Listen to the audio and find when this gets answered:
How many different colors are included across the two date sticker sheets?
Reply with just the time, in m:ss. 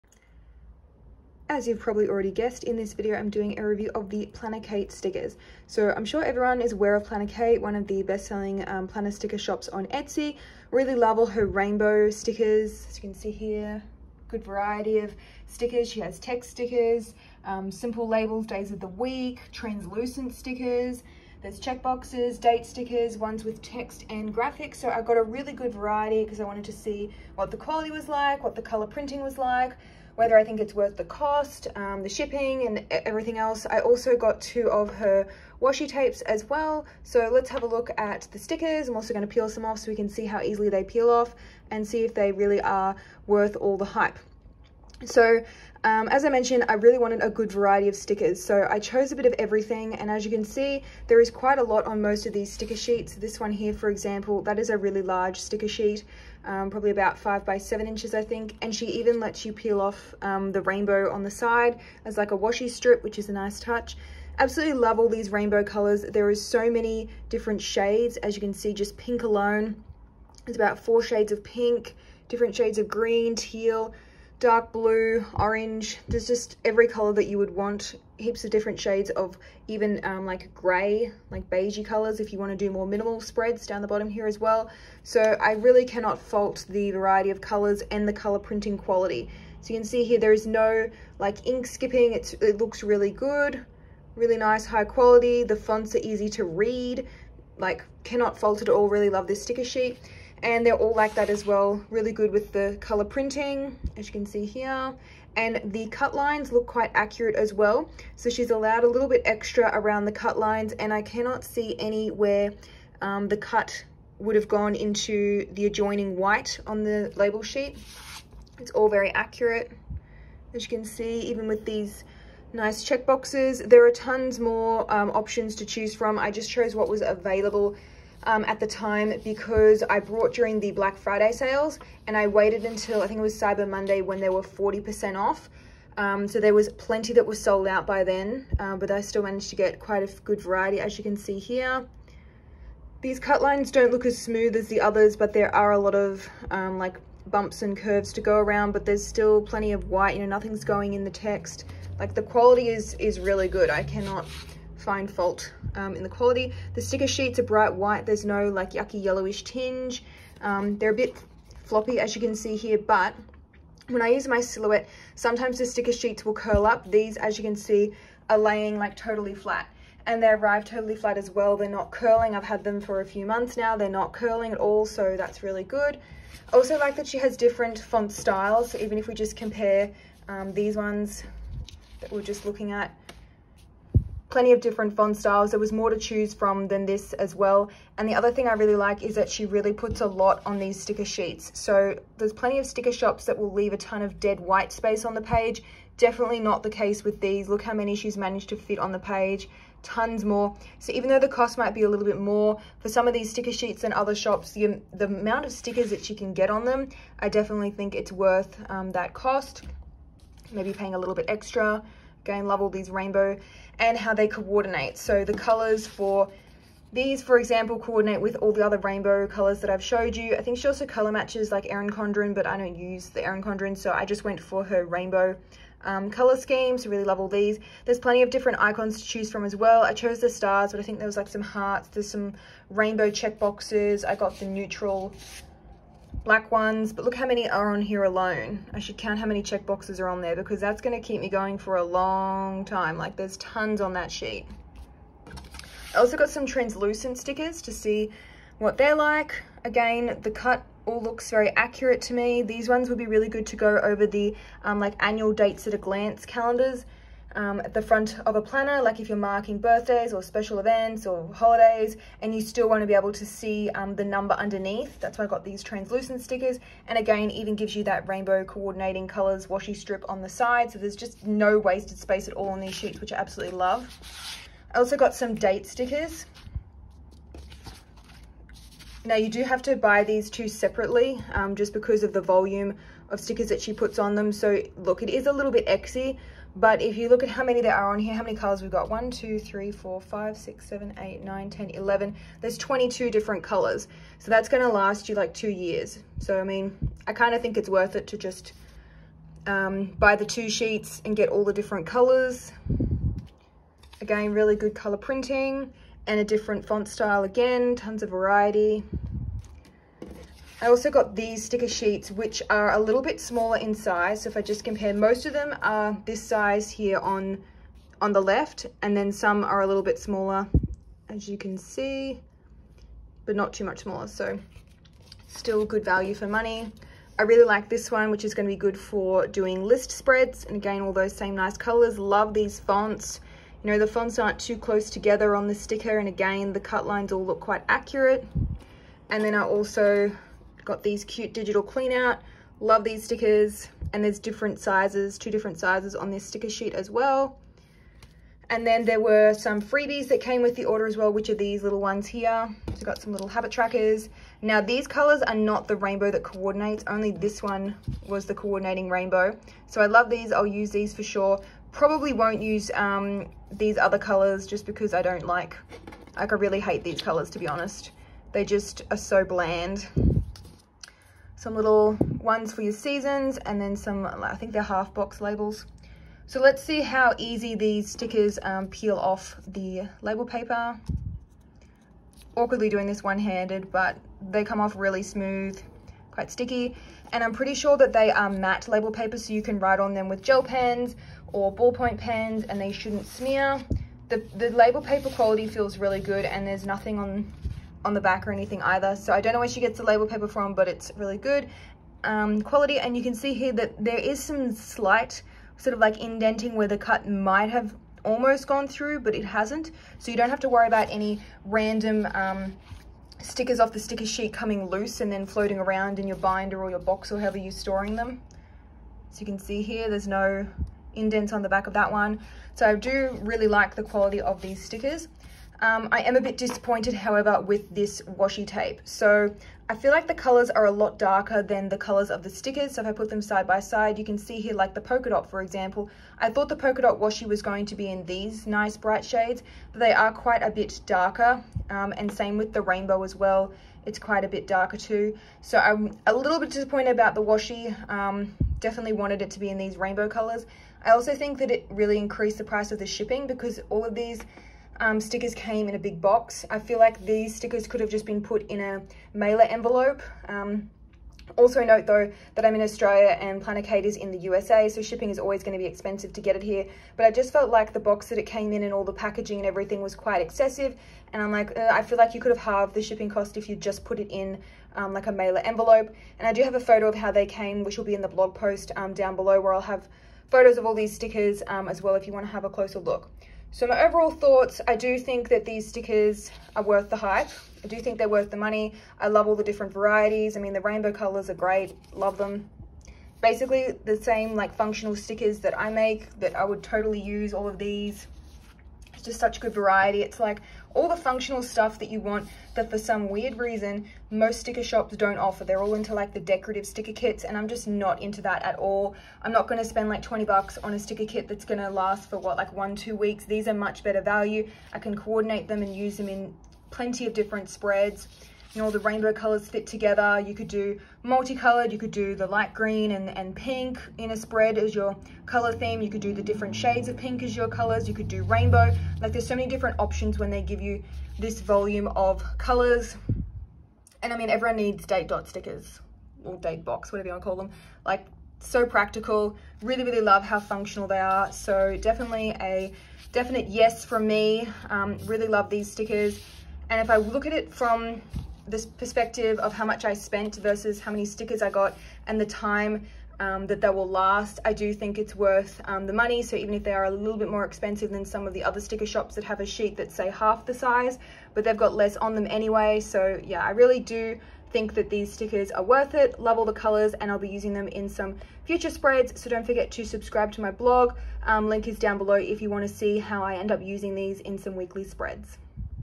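4:52.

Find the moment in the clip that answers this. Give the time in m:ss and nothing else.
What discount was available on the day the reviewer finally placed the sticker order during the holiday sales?
2:14.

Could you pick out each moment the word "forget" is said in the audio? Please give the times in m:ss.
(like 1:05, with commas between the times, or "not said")
9:29.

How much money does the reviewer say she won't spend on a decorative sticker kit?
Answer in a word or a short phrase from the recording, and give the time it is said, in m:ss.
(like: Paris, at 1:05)
$20, at 8:30.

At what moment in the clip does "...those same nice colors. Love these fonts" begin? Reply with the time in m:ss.
5:30.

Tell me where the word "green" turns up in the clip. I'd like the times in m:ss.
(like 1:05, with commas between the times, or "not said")
1:12, 8:42.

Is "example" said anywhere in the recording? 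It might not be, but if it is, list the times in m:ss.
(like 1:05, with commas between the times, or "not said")
0:53, 3:37, 7:15.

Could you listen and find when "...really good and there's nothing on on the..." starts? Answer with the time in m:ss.
6:35.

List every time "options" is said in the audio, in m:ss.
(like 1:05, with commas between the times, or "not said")
2:05, 8:49.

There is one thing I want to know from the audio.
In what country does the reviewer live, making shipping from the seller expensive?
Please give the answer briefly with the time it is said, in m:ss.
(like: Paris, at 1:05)
Australia, at 7:42.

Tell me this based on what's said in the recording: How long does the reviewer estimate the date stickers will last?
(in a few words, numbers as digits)
2 years.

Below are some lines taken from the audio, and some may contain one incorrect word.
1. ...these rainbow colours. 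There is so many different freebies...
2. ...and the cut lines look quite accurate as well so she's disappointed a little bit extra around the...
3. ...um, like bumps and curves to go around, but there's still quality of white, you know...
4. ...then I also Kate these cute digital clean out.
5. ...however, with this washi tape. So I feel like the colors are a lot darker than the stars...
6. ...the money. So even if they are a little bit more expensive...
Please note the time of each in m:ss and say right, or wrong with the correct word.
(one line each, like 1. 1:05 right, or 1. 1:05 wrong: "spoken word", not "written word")
1. 1:05 wrong: "shades", not "freebies"
2. 1:45 wrong: "allowed", not "disappointed"
3. 2:26 wrong: "plenty", not "quality"
4. 5:39 wrong: "Got", not "Kate"
5. 7:06 wrong: "colors", not "stars"
6. 9:15 right.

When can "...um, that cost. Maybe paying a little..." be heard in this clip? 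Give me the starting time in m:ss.
3:28.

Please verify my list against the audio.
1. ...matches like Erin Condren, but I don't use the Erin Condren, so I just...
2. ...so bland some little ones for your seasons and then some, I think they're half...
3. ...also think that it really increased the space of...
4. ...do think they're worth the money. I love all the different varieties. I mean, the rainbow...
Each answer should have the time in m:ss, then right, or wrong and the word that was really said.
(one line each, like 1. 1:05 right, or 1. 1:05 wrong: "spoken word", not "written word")
1. 3:41 right
2. 6:08 right
3. 7:30 wrong: "price", not "space"
4. 8:07 right.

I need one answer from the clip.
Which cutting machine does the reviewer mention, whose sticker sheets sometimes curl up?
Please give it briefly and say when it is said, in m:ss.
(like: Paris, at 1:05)
Silhouette, at 2:44.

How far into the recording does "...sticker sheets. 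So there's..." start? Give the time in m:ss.
3:10.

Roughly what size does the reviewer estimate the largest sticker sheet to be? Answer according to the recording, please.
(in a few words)
5 by 7 inches.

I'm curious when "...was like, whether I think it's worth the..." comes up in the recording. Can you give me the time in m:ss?
0:29.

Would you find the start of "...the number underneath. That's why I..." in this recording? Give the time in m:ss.
4:23.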